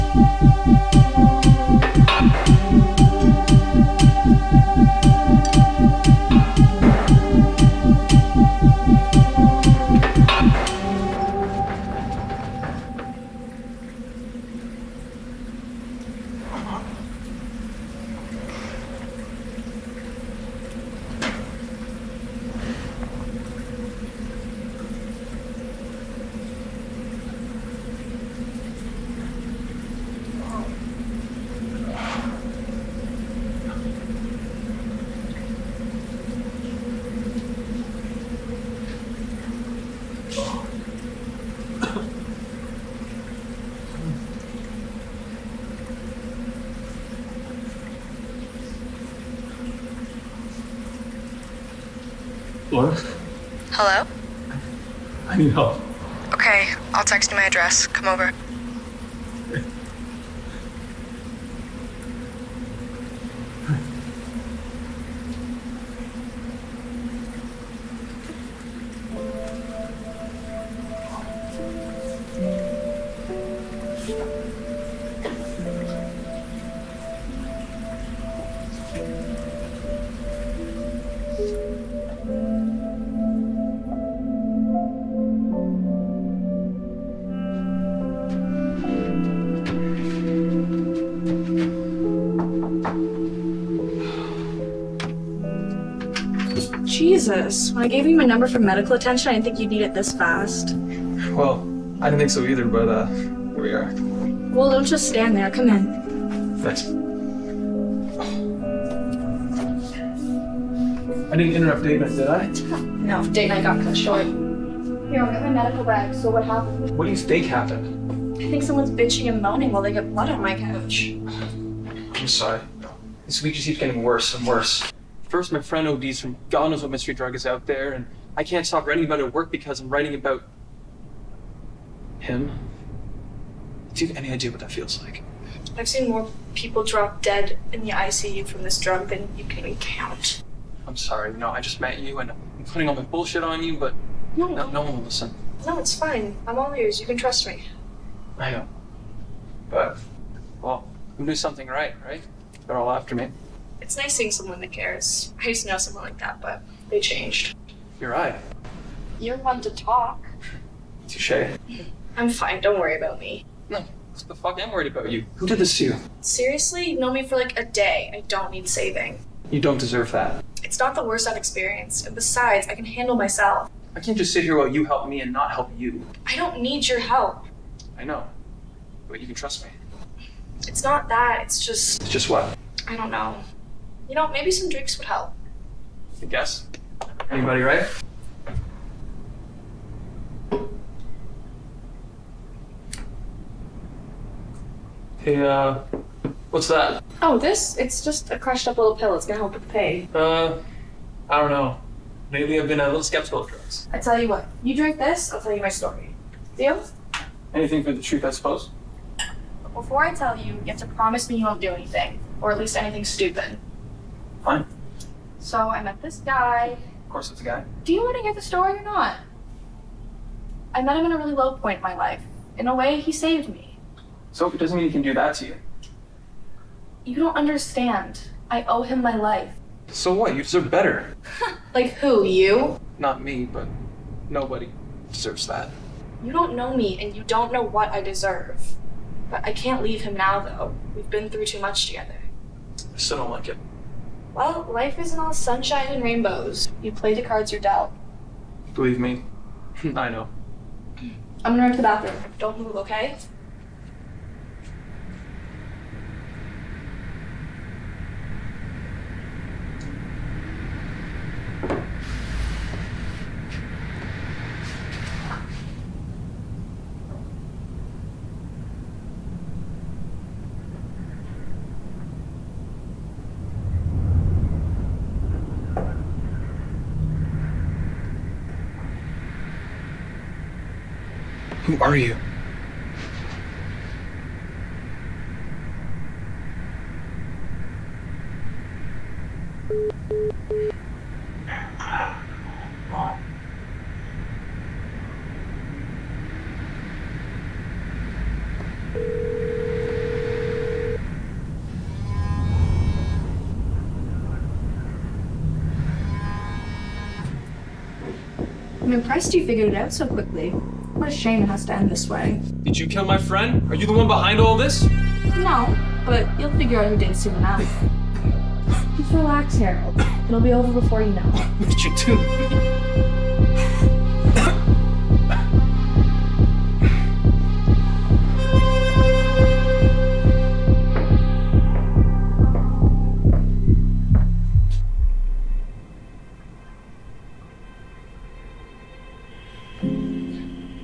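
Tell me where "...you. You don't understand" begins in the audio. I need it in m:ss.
3:45.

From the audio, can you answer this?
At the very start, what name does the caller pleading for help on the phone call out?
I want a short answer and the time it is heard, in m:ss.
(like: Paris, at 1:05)
Laura, at 0:52.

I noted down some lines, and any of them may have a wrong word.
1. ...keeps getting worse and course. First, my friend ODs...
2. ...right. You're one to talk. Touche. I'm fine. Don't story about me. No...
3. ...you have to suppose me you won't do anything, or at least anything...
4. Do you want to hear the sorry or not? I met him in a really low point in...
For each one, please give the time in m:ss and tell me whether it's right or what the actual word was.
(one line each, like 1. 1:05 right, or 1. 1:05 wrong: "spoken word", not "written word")
1. 2:03 wrong: "worse", not "course"
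2. 2:38 wrong: "worry", not "story"
3. 3:30 wrong: "promise", not "suppose"
4. 3:37 wrong: "story", not "sorry".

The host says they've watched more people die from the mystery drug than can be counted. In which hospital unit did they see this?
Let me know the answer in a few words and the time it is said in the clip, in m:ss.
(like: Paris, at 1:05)
ICU, at 2:17.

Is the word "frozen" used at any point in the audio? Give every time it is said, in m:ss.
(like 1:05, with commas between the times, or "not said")
not said.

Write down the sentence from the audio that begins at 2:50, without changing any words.
It's not the worst I've experienced.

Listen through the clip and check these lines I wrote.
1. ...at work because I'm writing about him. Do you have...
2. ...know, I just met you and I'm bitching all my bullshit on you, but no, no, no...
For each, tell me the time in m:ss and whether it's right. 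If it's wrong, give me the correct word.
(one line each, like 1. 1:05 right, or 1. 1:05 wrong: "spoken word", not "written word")
1. 2:09 right
2. 2:21 wrong: "putting", not "bitching".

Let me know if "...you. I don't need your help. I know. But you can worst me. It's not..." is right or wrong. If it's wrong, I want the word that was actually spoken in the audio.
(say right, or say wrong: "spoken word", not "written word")
wrong: "trust", not "worst".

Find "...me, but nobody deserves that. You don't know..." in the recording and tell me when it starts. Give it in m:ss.
3:53.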